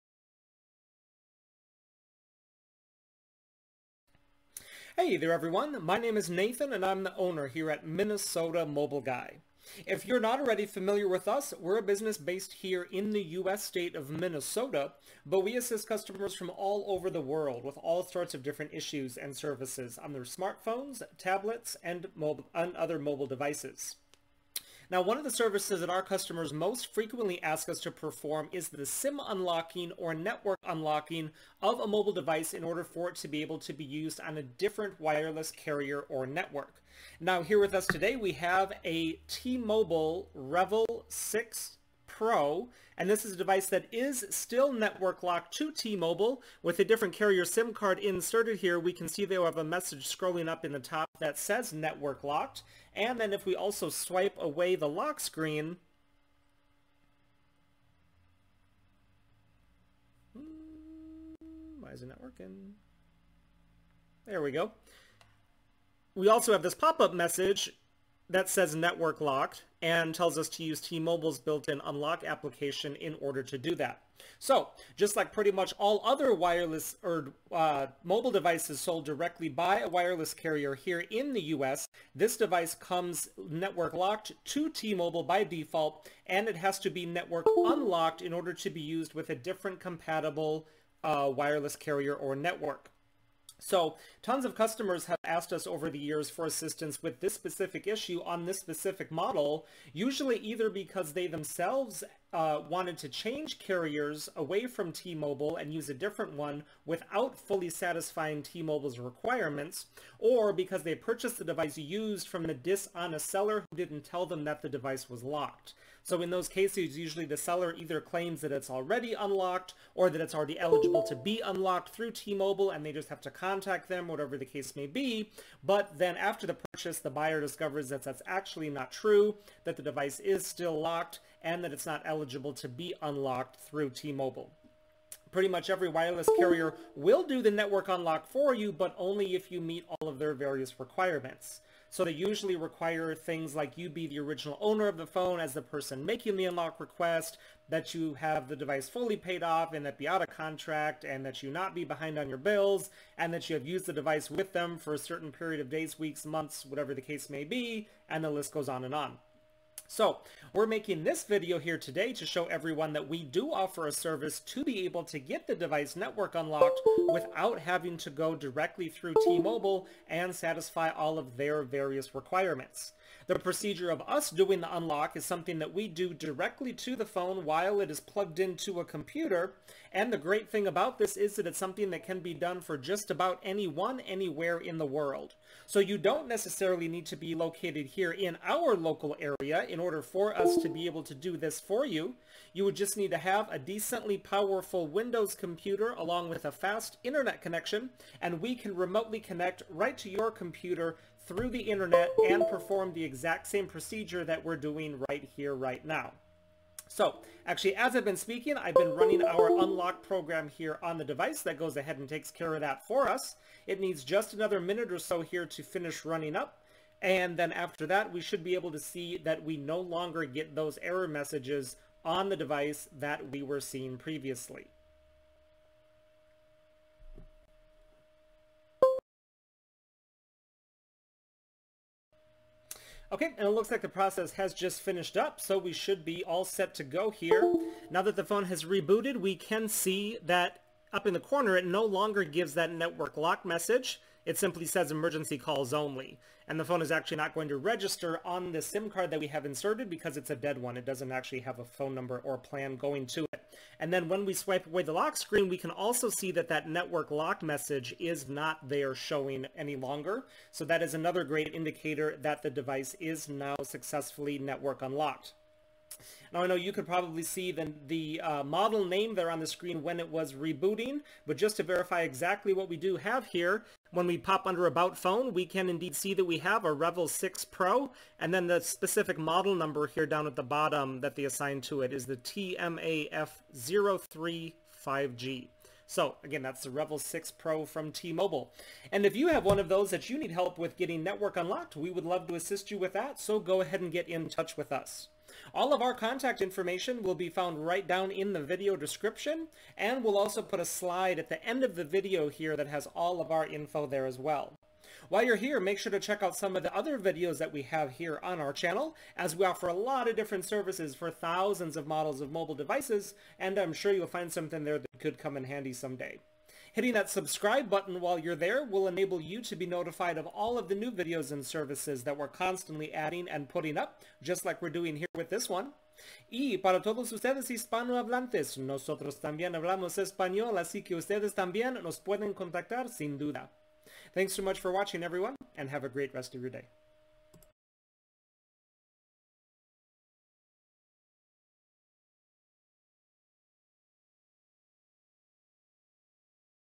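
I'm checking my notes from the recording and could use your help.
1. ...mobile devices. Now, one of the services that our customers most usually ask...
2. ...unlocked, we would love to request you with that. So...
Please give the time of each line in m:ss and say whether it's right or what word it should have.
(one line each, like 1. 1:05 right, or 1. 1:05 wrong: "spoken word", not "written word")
1. 0:22 wrong: "frequently", not "usually"
2. 4:51 wrong: "assist", not "request".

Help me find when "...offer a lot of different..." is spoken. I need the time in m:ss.
5:09.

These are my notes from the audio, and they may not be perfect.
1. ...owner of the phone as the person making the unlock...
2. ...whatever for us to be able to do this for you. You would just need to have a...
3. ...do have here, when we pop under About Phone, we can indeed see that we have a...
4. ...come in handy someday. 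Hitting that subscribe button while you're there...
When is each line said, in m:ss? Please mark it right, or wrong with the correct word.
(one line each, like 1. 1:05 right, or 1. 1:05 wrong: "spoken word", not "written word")
1. 2:24 right
2. 3:09 wrong: "order", not "whatever"
3. 4:32 right
4. 5:15 right.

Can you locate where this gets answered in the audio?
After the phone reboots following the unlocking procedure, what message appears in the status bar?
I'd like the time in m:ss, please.
4:04.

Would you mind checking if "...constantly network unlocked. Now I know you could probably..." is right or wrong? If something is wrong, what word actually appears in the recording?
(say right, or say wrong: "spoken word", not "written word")
wrong: "successfully", not "constantly".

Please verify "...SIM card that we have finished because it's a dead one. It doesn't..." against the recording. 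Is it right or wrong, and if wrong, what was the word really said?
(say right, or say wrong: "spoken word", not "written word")
wrong: "inserted", not "finished".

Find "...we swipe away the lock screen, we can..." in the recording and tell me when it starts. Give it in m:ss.
4:14.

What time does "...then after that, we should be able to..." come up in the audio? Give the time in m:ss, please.
3:37.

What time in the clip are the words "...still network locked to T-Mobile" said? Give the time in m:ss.
0:44.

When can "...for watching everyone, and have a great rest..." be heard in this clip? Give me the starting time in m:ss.
5:34.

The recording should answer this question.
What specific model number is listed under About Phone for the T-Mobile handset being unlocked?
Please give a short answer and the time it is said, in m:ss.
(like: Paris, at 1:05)
TMAF035G, at 4:42.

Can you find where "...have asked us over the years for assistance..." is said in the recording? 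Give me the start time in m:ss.
1:35.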